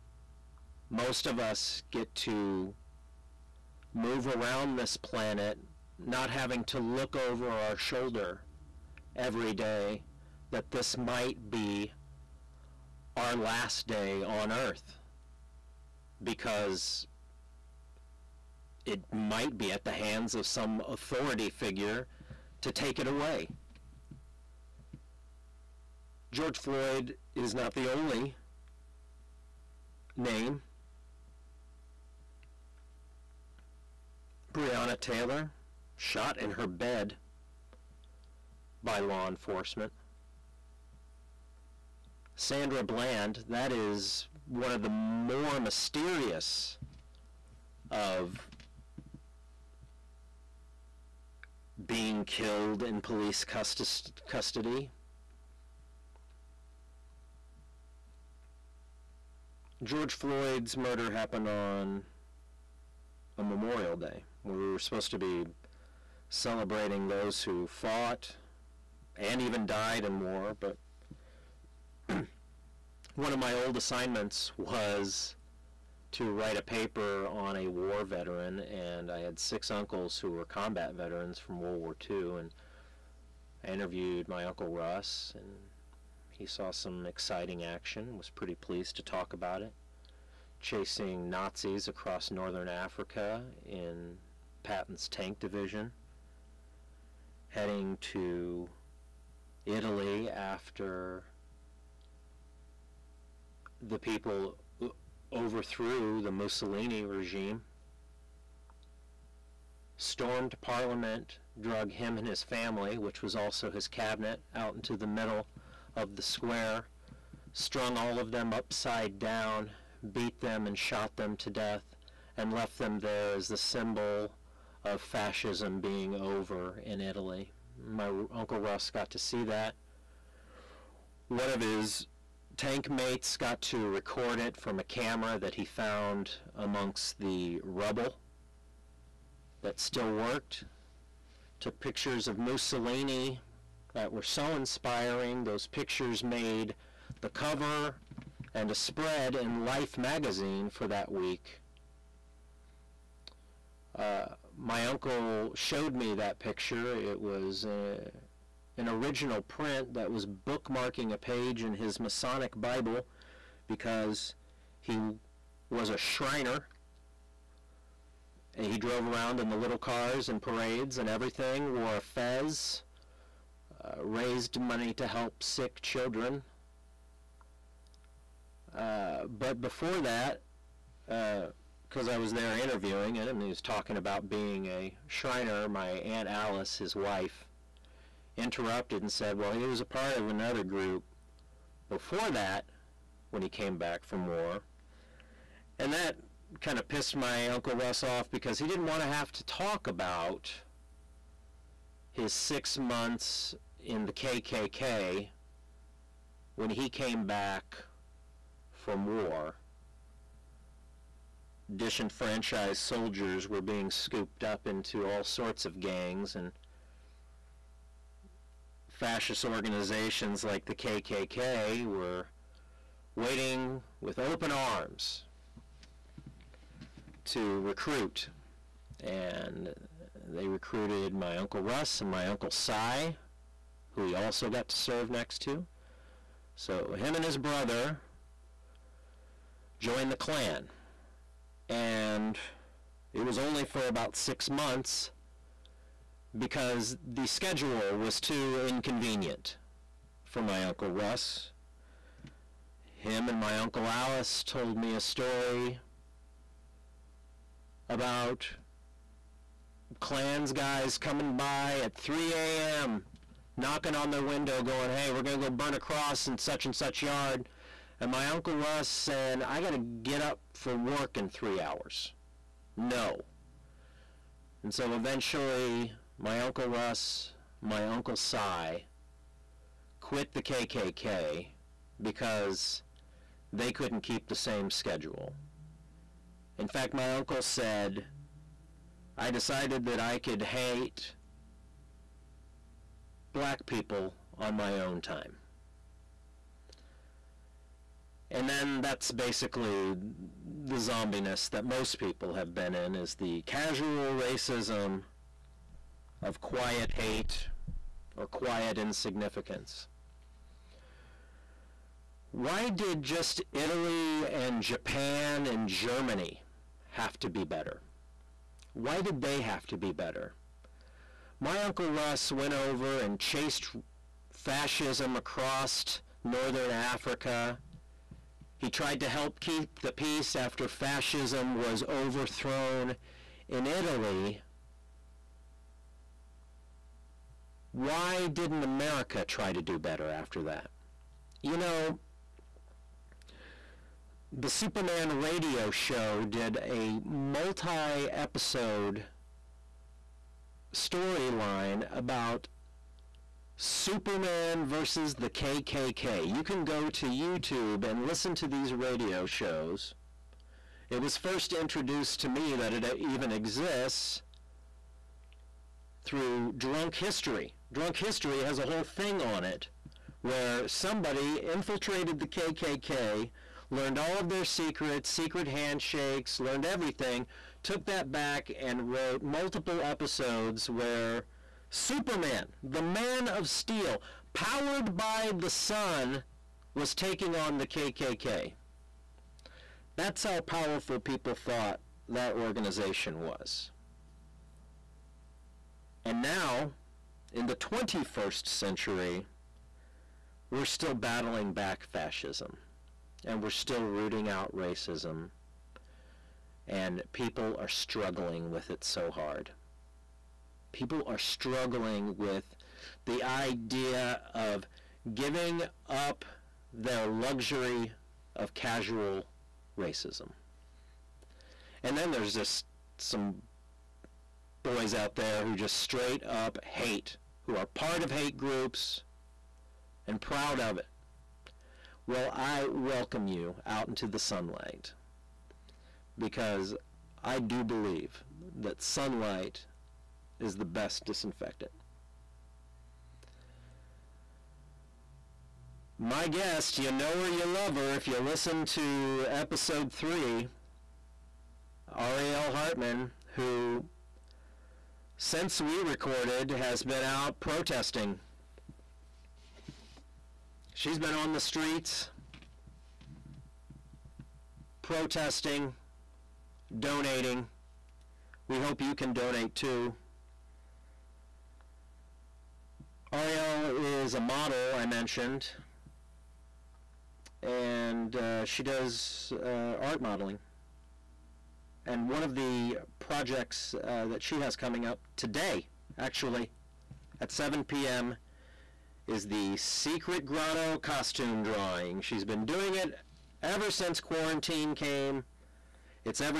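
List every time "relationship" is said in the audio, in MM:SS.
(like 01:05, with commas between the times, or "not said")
not said.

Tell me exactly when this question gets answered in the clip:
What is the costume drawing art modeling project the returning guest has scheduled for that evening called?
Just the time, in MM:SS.
08:09.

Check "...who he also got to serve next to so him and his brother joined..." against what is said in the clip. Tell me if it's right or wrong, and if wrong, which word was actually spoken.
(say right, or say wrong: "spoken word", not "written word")
right.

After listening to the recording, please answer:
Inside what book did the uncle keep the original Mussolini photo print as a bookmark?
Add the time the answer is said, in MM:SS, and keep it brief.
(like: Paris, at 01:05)
Masonic Bible, at 02:41.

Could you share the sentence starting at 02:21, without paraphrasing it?
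Took pictures of Mussolini that were so inspiring.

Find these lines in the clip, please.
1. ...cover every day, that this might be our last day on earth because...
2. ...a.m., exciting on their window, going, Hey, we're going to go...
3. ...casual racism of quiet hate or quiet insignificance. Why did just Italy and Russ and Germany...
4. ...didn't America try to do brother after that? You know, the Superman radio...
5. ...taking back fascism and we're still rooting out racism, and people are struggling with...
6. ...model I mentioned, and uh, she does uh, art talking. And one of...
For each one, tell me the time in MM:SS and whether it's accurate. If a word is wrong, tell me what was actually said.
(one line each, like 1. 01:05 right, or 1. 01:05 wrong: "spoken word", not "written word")
1. 00:07 wrong: "shoulder", not "cover"
2. 04:22 wrong: "knocking", not "exciting"
3. 05:03 wrong: "Japan", not "Russ"
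4. 05:38 wrong: "better", not "brother"
5. 06:40 wrong: "battling", not "taking"
6. 07:54 wrong: "modeling", not "talking".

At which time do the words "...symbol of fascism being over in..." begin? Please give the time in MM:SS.
02:03.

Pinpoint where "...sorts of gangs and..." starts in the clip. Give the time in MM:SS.
03:35.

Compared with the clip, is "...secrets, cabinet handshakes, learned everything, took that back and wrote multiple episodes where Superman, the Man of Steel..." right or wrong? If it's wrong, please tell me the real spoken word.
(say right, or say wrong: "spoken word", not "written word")
wrong: "secret", not "cabinet".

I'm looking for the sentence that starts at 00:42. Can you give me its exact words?
Sandra Bland, that is one of the more mysterious of being killed in police custody.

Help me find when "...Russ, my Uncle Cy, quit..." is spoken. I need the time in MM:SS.
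04:36.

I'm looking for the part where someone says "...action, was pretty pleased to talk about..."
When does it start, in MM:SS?
01:27.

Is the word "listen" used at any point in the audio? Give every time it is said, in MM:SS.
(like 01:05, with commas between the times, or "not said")
05:58, 07:28.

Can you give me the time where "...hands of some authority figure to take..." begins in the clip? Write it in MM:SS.
00:19.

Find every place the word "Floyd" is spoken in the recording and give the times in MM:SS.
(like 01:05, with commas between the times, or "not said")
00:26, 01:00.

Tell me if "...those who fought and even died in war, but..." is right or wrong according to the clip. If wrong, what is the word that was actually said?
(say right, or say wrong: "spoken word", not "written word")
right.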